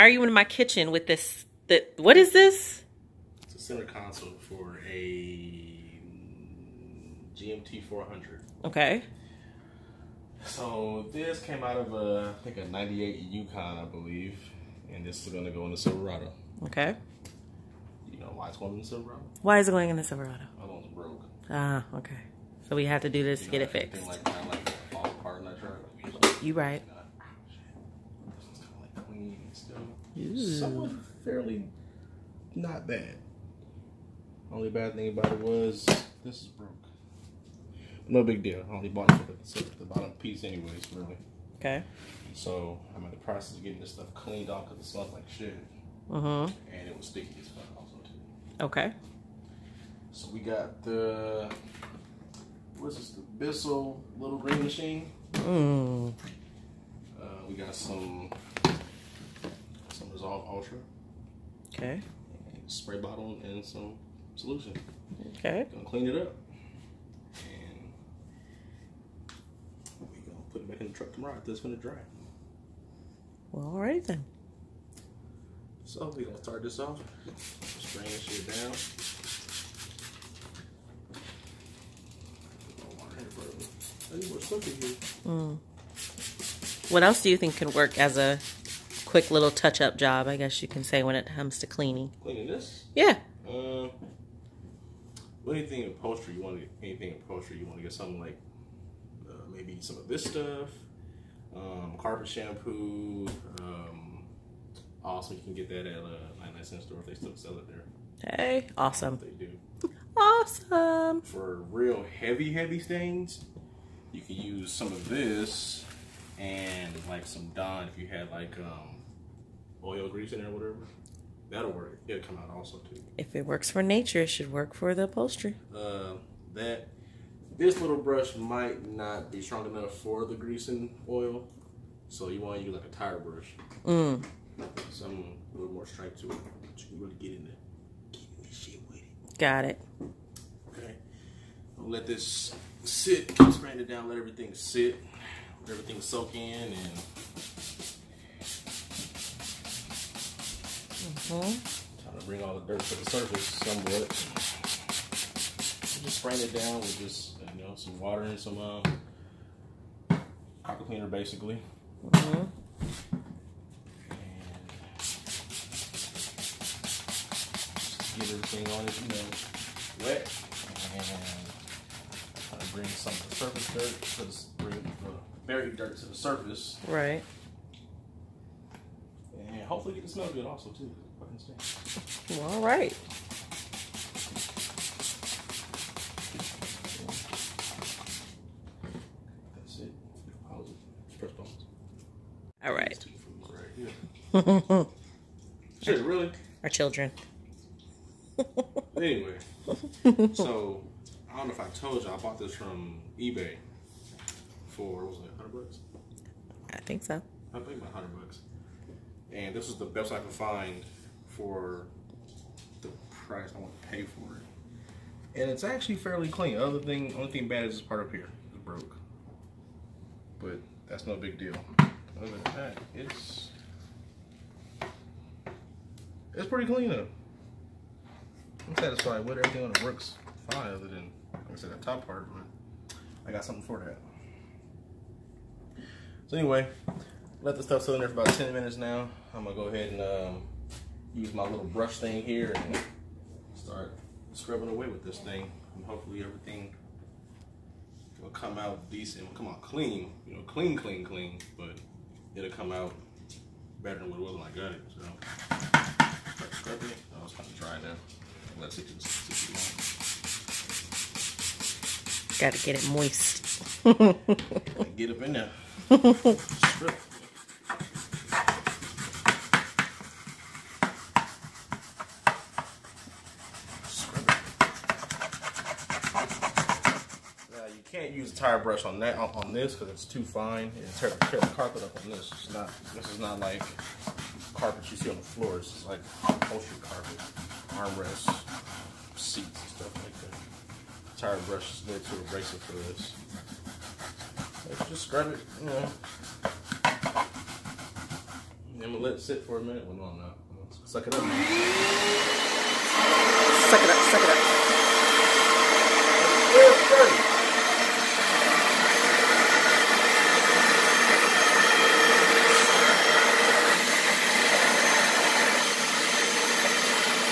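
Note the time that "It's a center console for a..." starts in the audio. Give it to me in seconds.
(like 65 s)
3 s.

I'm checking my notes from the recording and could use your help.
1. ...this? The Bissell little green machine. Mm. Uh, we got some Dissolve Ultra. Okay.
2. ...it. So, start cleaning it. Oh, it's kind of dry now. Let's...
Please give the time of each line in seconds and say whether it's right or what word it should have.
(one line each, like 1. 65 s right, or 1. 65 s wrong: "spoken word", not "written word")
1. 52 s right
2. 254 s wrong: "scrubbing", not "cleaning".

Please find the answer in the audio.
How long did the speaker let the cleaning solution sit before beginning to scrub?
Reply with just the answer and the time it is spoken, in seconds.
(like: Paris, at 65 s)
10 minutes, at 238 s.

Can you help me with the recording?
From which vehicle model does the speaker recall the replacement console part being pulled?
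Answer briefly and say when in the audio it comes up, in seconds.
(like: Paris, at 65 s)
98 Yukon, at 12 s.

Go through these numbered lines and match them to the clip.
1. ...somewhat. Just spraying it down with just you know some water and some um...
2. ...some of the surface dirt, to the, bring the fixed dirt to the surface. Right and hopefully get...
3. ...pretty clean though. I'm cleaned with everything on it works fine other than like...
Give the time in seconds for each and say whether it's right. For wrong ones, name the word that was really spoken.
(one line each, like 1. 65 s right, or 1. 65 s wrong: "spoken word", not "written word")
1. 153 s right
2. 172 s wrong: "buried", not "fixed"
3. 226 s wrong: "satisfied", not "cleaned".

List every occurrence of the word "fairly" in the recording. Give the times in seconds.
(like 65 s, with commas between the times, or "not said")
31 s, 215 s.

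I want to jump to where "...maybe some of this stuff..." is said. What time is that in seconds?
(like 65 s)
99 s.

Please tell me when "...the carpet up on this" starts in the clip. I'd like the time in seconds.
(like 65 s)
281 s.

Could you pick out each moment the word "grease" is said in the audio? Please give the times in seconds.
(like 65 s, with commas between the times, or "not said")
120 s, 130 s.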